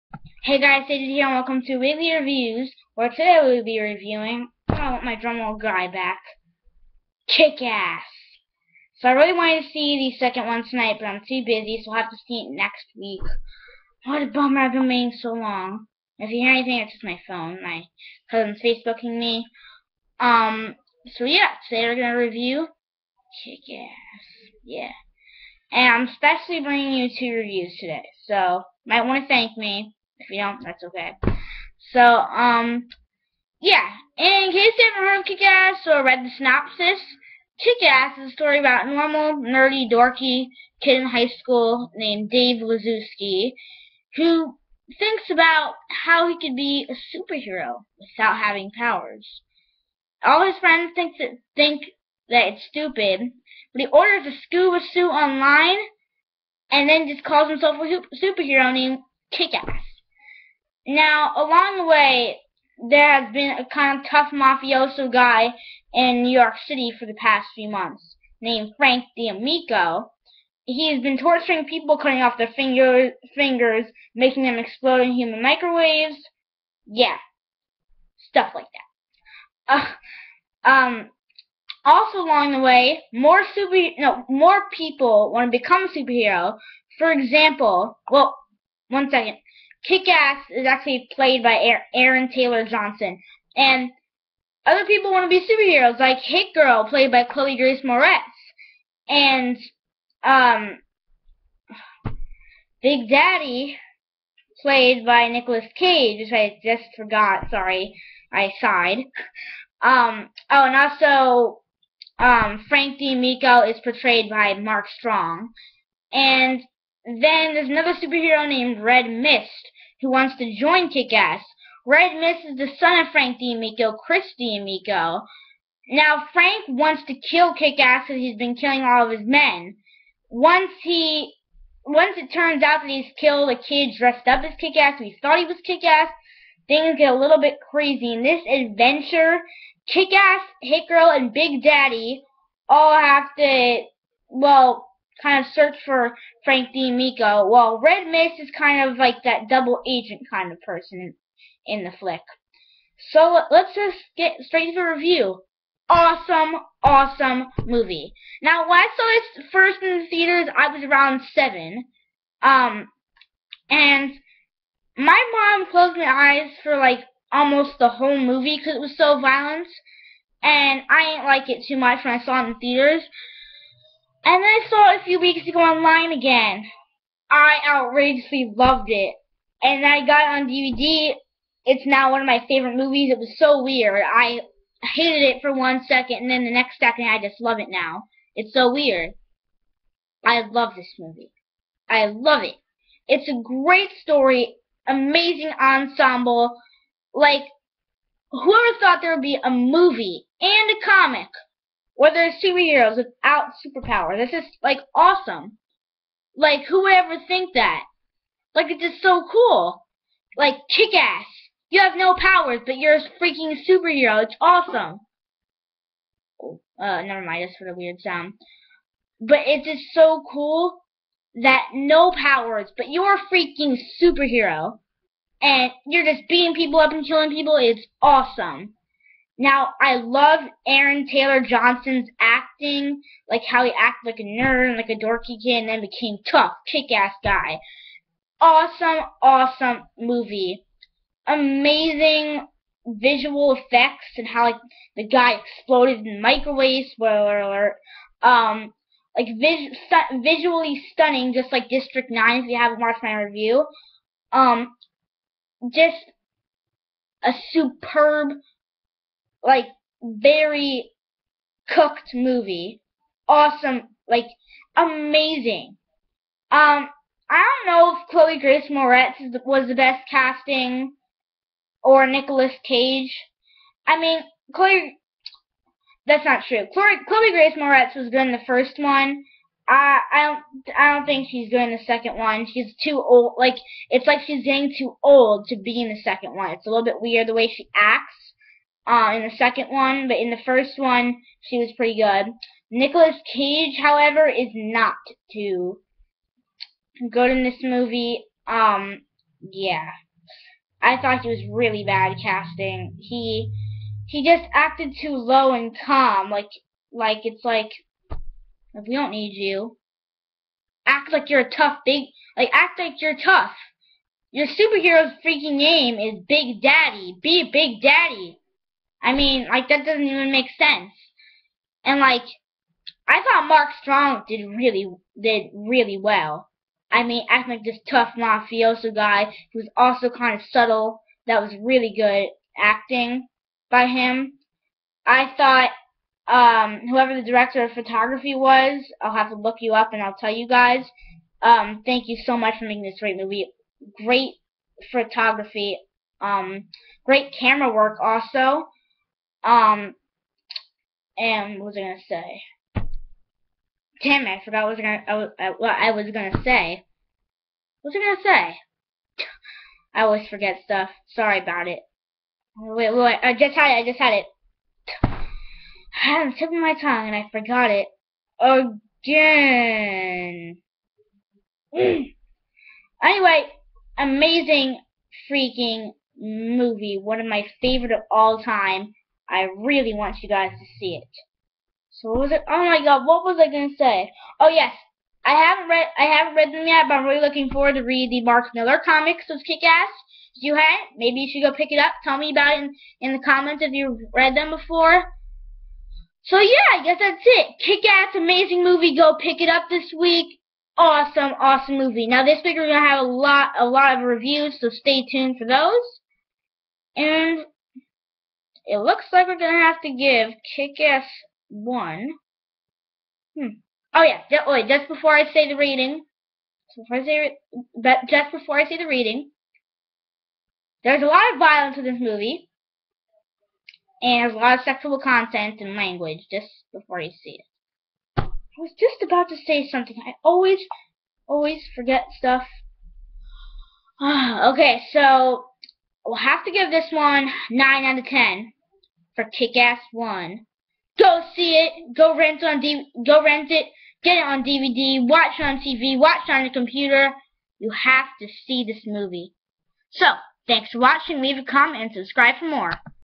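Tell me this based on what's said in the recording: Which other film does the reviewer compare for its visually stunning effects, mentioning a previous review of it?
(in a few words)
District 9.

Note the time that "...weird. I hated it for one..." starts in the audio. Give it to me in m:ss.
3:03.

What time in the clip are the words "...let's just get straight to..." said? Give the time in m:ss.
2:33.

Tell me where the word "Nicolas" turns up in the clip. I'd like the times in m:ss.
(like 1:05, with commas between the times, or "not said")
1:45, 4:32, 4:52.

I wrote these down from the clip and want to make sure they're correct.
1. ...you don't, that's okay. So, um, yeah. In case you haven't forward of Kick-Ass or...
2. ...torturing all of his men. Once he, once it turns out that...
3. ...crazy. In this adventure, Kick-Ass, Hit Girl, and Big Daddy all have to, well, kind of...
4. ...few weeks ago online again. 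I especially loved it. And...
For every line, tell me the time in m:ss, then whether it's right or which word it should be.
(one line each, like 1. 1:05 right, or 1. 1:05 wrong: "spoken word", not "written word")
1. 0:30 wrong: "heard", not "forward"
2. 2:08 wrong: "killing", not "torturing"
3. 2:17 right
4. 2:55 wrong: "outrageously", not "especially".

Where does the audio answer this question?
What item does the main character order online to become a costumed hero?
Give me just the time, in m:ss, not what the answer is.
0:54.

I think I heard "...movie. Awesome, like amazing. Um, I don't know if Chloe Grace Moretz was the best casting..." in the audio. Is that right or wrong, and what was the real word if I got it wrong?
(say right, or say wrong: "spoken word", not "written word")
right.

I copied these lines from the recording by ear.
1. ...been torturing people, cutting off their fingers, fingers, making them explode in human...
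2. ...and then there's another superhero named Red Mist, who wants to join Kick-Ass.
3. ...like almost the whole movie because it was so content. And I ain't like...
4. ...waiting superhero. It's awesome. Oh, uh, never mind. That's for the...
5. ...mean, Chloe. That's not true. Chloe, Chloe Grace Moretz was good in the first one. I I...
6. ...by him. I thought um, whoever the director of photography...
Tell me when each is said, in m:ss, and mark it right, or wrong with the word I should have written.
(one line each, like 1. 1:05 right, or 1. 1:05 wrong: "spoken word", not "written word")
1. 1:11 right
2. 1:56 right
3. 2:46 wrong: "violent", not "content"
4. 3:33 wrong: "freaking", not "waiting"
5. 4:33 right
6. 5:33 right.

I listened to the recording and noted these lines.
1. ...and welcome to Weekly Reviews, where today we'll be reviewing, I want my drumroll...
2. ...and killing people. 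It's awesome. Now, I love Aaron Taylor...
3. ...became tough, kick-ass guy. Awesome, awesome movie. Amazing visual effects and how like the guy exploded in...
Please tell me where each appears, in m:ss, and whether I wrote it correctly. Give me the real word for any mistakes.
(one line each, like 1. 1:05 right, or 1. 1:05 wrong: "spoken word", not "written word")
1. 0:01 right
2. 3:46 right
3. 3:55 right.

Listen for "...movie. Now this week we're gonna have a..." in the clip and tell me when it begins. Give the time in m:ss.
6:41.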